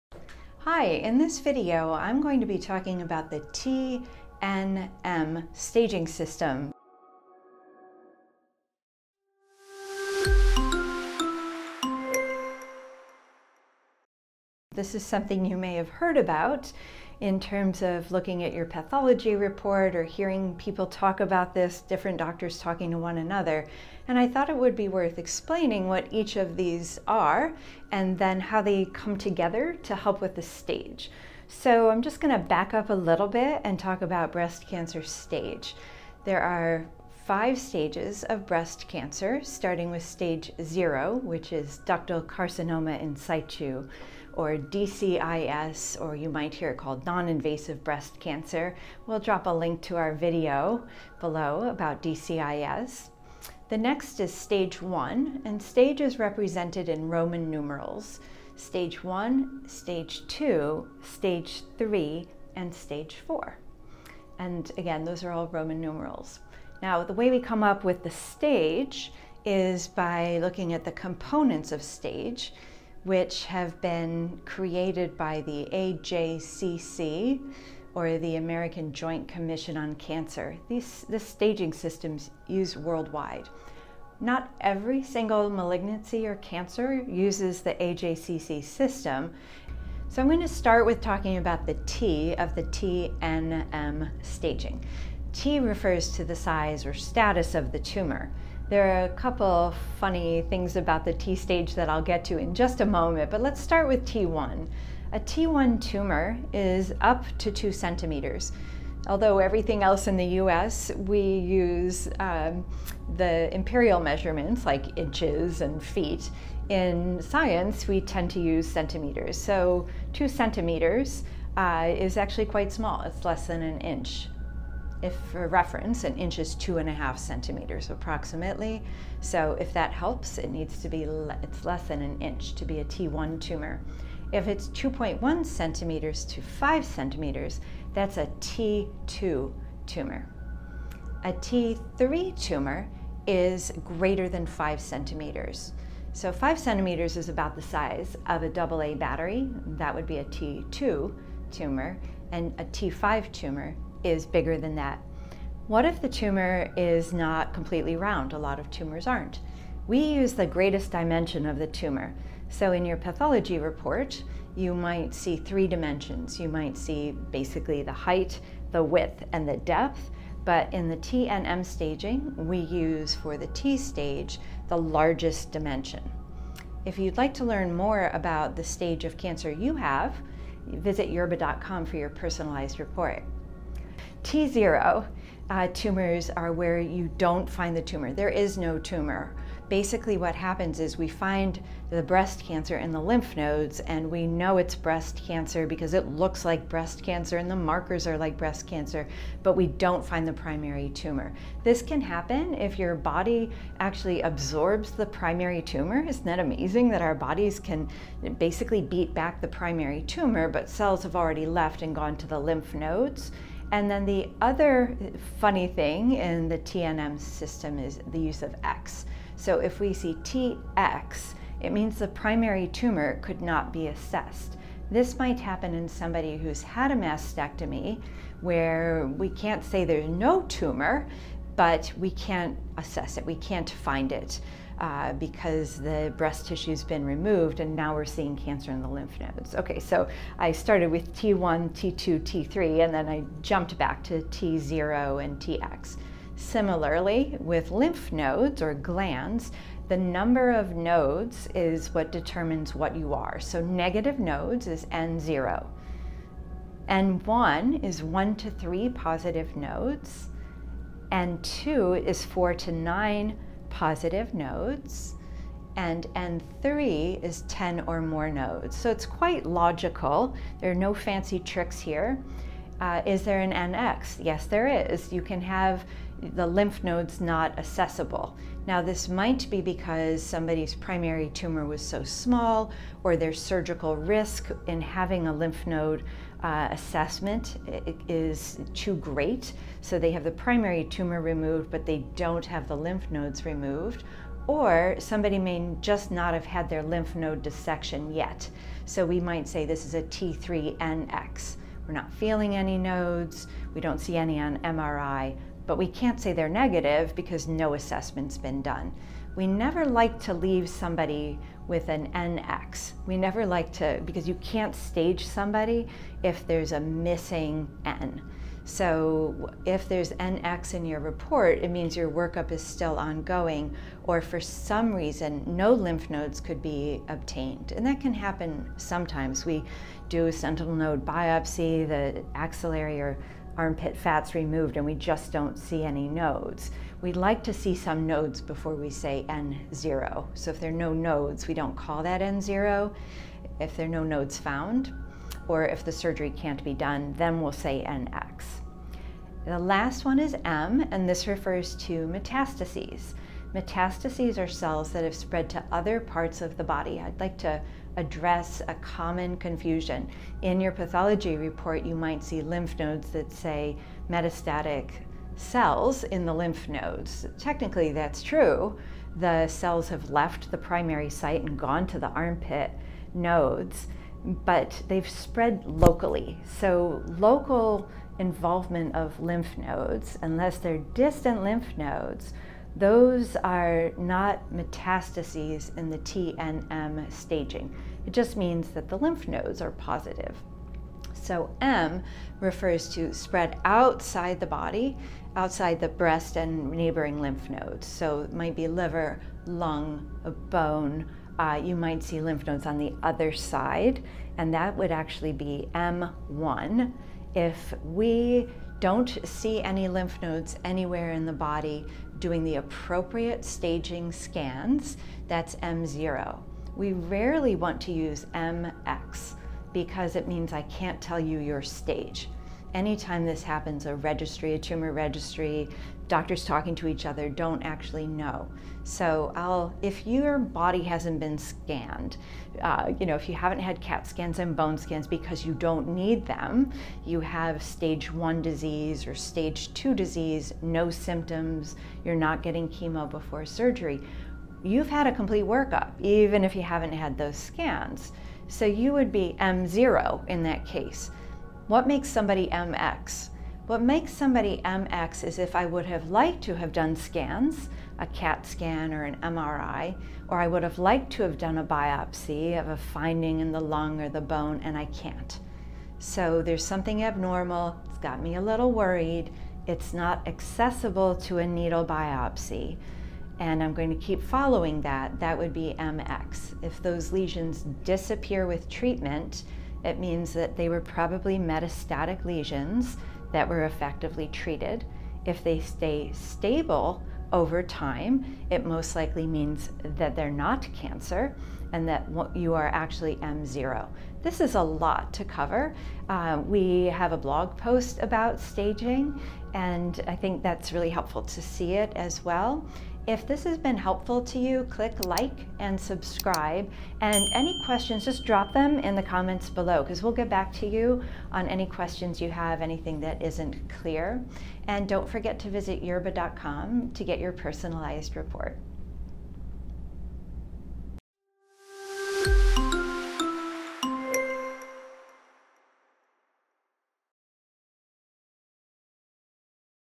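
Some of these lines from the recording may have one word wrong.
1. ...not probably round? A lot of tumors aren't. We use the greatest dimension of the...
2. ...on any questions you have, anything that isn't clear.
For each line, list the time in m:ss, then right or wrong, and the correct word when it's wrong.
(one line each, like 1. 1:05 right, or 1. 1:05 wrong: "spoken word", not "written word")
1. 2:37 wrong: "completely", not "probably"
2. 8:31 right.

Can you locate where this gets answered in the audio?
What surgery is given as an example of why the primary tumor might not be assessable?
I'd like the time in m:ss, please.
3:46.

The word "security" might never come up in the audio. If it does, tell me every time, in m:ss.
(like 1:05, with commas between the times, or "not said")
not said.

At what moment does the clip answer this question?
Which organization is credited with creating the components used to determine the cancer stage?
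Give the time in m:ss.
1:18.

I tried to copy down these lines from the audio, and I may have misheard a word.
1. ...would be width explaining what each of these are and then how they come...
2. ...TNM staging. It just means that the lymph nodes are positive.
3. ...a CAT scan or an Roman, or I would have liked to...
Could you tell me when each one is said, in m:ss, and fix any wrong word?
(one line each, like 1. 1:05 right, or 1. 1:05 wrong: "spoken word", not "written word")
1. 0:24 wrong: "worth", not "width"
2. 6:25 right
3. 7:37 wrong: "MRI", not "Roman".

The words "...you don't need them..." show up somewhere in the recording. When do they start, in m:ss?
7:15.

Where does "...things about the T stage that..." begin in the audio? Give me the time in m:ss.
1:40.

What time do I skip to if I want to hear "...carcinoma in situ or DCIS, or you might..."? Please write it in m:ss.
0:42.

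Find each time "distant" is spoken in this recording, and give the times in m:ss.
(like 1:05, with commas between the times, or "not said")
6:20.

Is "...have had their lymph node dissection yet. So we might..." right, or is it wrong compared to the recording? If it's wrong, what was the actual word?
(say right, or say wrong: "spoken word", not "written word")
right.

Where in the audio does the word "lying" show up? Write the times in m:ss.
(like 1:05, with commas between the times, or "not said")
not said.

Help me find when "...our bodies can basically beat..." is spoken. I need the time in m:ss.
3:27.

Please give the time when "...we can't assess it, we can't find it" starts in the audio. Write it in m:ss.
3:51.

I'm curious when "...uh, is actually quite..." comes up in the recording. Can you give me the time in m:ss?
2:01.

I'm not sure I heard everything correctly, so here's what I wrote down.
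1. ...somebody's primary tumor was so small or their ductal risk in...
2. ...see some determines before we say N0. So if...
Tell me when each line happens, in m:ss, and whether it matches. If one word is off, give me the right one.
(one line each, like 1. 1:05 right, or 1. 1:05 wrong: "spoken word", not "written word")
1. 4:40 wrong: "surgical", not "ductal"
2. 5:37 wrong: "nodes", not "determines".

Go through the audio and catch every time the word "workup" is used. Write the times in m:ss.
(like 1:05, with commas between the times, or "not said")
5:22, 7:25.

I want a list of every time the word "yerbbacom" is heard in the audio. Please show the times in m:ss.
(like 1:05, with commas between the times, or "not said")
3:01, 8:35.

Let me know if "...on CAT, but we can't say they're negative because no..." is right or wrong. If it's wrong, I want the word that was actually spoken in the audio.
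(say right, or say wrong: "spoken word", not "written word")
wrong: "MRI", not "CAT".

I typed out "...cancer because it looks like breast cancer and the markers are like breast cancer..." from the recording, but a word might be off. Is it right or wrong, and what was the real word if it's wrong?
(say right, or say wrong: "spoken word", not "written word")
right.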